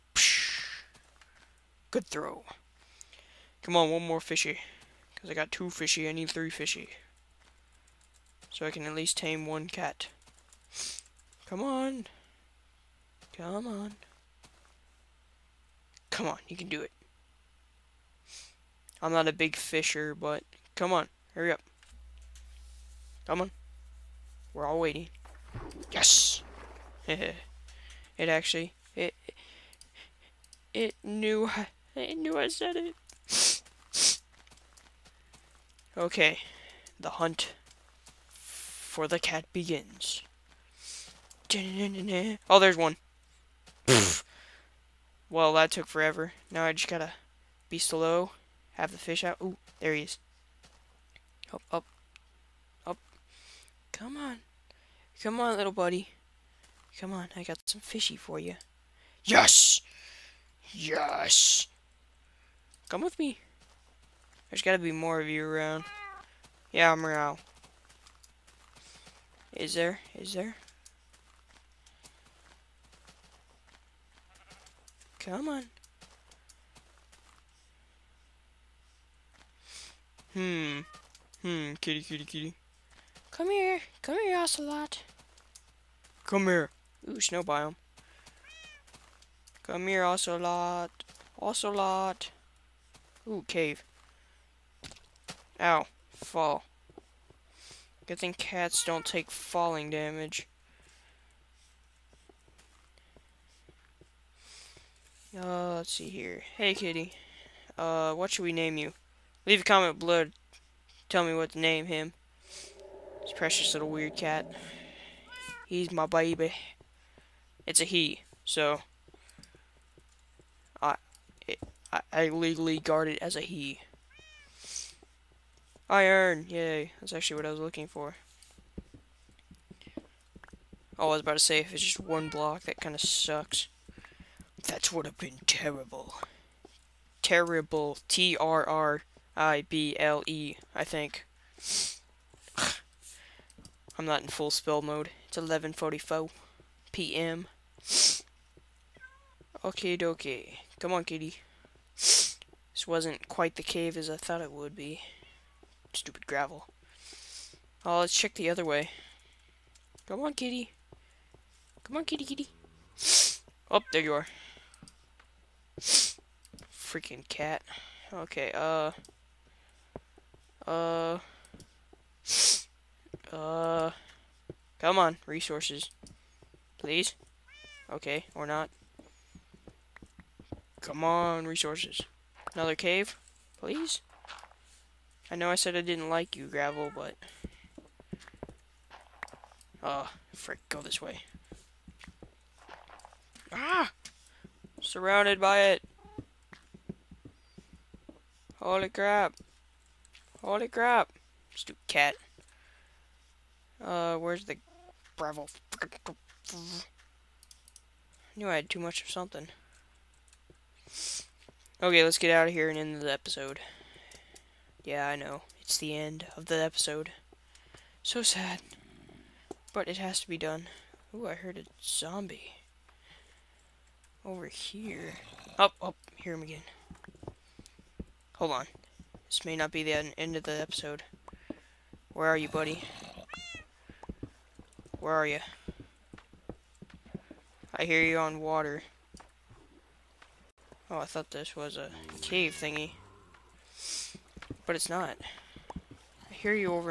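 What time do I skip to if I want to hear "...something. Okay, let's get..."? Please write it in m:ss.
3:29.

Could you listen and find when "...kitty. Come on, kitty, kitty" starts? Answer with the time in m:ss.
2:40.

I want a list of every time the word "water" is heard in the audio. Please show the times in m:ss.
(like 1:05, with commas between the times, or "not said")
3:58.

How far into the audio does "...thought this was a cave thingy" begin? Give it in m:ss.
4:01.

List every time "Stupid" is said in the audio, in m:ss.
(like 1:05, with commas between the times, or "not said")
2:35, 3:21.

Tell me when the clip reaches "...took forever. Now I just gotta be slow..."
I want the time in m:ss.
0:45.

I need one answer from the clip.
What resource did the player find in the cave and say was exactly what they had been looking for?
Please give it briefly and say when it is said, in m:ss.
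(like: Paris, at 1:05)
Iron, at 2:05.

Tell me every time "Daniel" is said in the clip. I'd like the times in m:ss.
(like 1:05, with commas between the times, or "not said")
not said.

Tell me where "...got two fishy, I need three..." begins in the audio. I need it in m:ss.
0:05.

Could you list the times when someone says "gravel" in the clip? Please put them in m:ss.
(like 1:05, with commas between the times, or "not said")
2:36, 3:06, 3:25.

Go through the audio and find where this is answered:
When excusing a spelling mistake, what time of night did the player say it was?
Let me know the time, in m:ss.
2:25.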